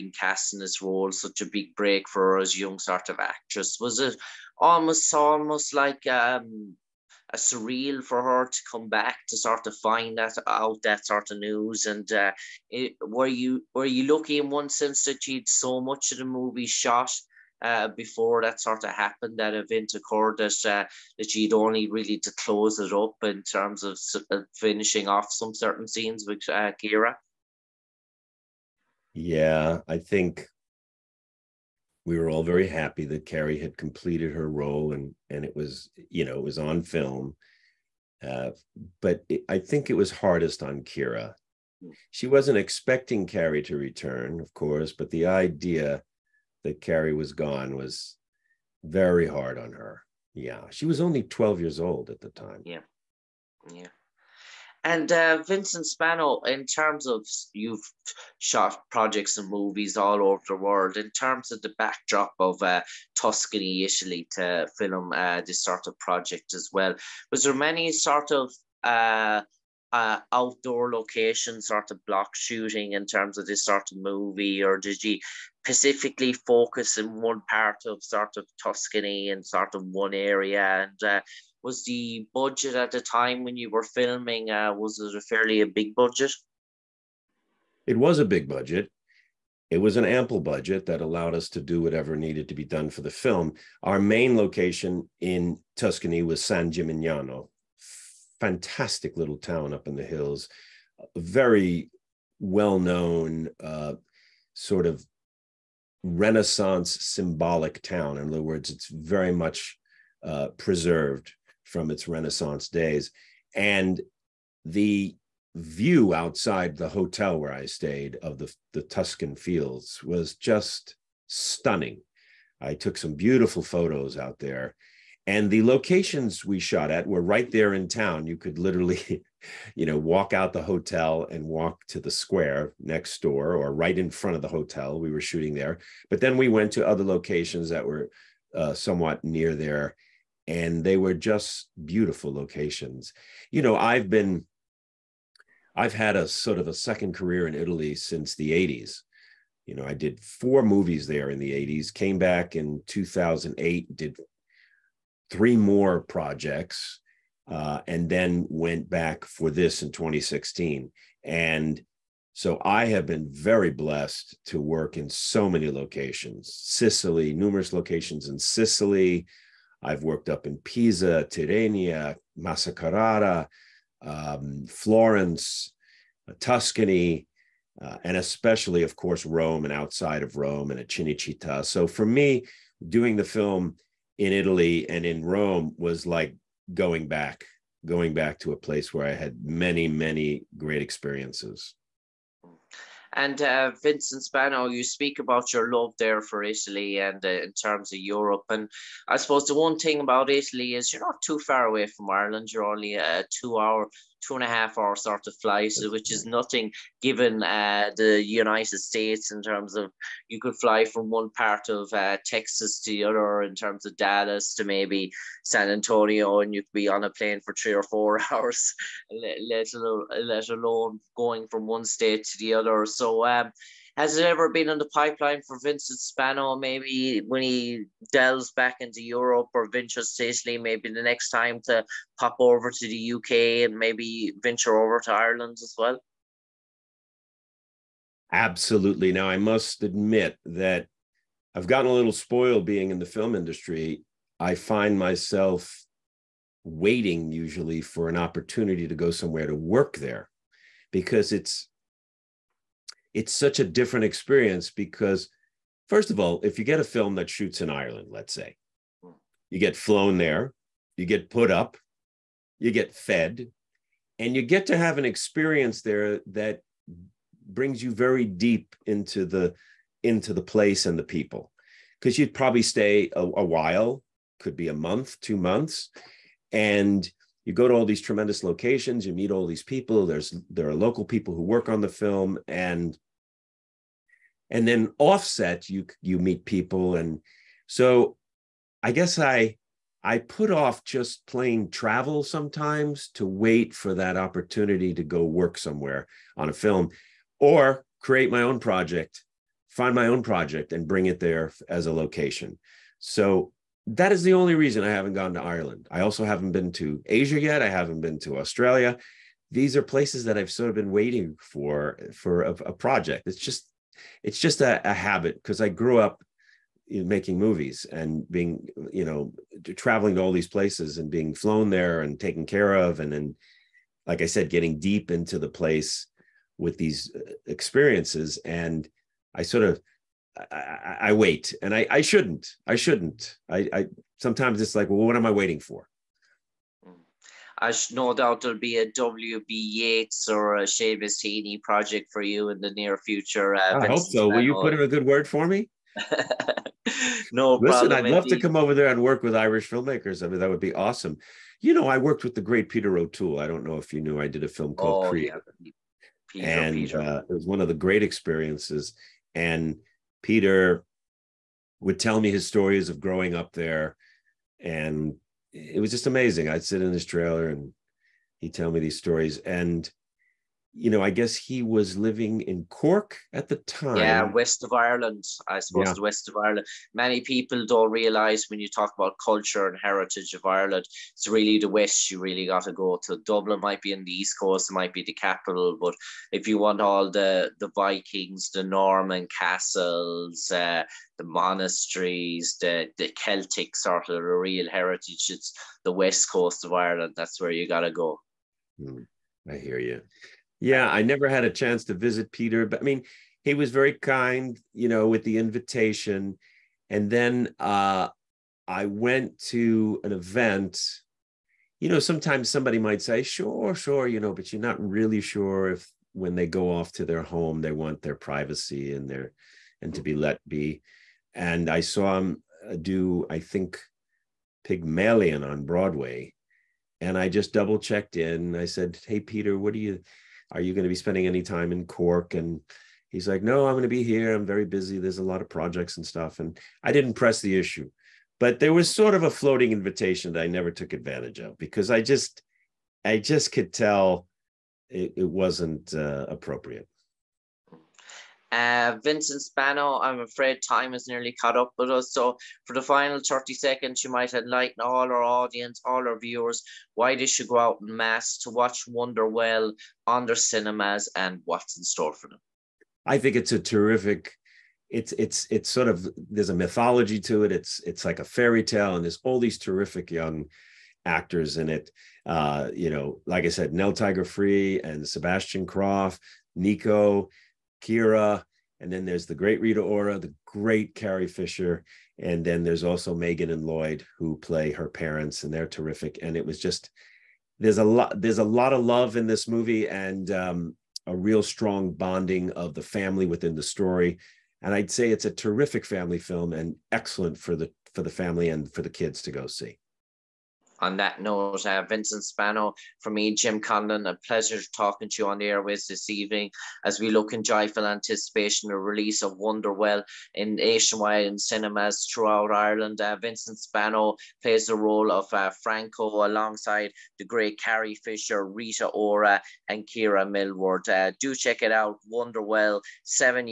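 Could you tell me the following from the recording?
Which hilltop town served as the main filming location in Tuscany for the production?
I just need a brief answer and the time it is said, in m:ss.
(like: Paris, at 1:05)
San Gimignano, at 1:36.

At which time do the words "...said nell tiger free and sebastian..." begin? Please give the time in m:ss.
7:53.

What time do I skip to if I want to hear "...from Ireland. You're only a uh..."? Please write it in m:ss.
3:21.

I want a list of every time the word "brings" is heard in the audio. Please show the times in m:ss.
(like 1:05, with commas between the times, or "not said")
4:27, 5:00.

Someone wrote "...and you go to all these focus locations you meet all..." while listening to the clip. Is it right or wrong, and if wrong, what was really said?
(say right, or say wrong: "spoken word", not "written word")
wrong: "tremendous", not "focus".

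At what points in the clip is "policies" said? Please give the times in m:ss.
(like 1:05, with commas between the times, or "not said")
not said.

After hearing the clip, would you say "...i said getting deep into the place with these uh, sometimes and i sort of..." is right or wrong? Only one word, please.
wrong.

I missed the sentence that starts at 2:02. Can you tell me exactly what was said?
I took some beautiful photos out there.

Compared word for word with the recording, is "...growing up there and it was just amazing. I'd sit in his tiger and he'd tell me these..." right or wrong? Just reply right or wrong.
wrong.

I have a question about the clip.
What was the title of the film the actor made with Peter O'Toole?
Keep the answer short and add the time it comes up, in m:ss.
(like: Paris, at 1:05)
Oh, Creator, at 5:55.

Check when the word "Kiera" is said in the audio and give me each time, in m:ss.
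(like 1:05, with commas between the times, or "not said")
0:26, 0:40, 7:57, 8:39.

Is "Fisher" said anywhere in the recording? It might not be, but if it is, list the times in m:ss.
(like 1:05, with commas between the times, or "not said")
8:01, 8:37.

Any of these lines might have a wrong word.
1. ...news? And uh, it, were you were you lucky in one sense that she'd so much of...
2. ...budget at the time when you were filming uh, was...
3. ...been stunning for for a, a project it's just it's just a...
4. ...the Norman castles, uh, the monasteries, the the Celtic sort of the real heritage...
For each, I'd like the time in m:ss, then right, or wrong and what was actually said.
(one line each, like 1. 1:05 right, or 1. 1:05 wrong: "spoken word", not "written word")
1. 0:11 right
2. 1:22 right
3. 5:10 wrong: "waiting", not "stunning"
4. 6:28 right.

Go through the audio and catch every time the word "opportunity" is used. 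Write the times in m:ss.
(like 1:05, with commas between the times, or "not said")
4:08, 4:54.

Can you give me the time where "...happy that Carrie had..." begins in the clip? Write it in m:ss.
0:32.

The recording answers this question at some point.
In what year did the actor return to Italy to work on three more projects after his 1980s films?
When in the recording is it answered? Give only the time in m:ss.
2:32.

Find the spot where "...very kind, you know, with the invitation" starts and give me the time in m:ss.
6:43.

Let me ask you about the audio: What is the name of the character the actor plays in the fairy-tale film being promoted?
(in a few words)
Franco.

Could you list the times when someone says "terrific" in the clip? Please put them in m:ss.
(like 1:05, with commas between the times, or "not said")
7:43, 7:49, 8:05, 8:15.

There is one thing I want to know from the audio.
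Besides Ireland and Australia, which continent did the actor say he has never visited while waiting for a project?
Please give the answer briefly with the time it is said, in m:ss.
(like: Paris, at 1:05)
Asia, at 5:07.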